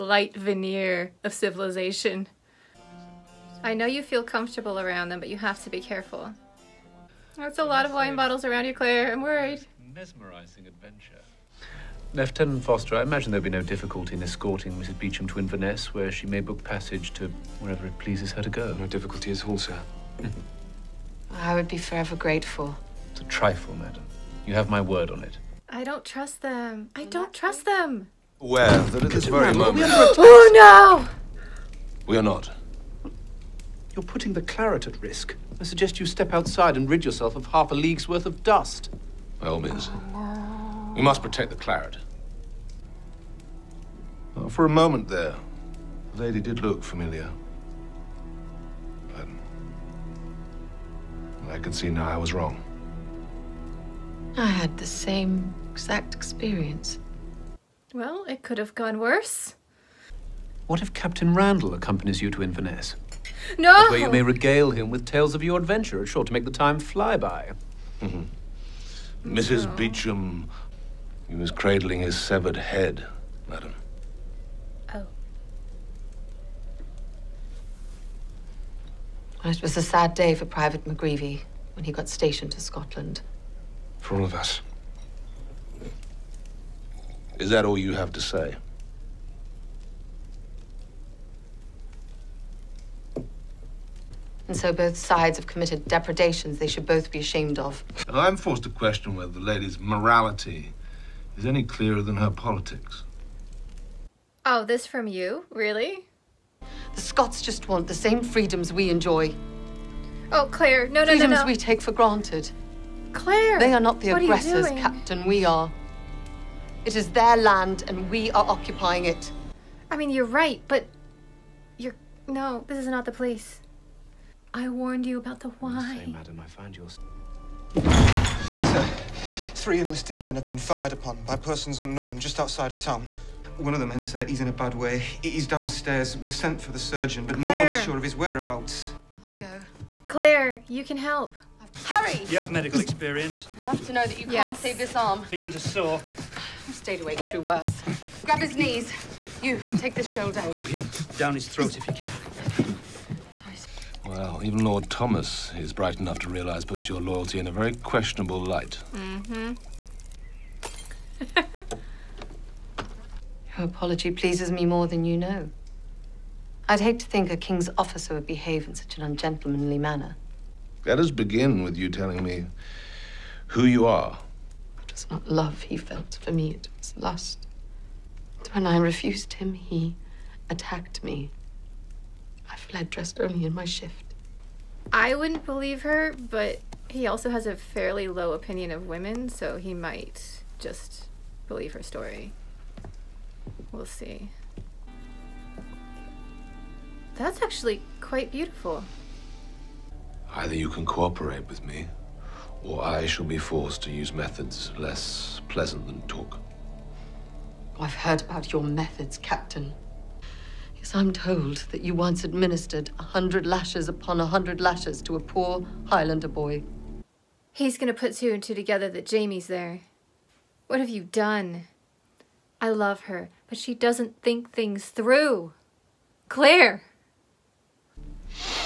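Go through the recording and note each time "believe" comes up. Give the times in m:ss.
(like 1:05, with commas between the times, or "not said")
3:05, 3:11.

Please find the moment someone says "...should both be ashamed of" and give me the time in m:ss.
1:36.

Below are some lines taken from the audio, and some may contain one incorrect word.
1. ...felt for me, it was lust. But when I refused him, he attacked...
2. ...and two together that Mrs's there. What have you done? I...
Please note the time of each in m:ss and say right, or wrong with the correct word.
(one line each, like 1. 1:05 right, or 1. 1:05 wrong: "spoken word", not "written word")
1. 2:55 right
2. 3:38 wrong: "Jamie", not "Mrs".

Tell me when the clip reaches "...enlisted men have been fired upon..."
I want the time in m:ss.
2:09.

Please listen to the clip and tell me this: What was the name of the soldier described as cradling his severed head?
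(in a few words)
Private McGreevy.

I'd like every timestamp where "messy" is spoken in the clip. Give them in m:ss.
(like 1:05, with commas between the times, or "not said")
not said.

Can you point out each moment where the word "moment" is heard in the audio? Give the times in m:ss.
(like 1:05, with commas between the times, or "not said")
0:29, 0:44.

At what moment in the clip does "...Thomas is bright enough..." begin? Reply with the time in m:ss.
2:34.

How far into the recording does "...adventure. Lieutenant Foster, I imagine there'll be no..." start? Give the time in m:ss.
0:10.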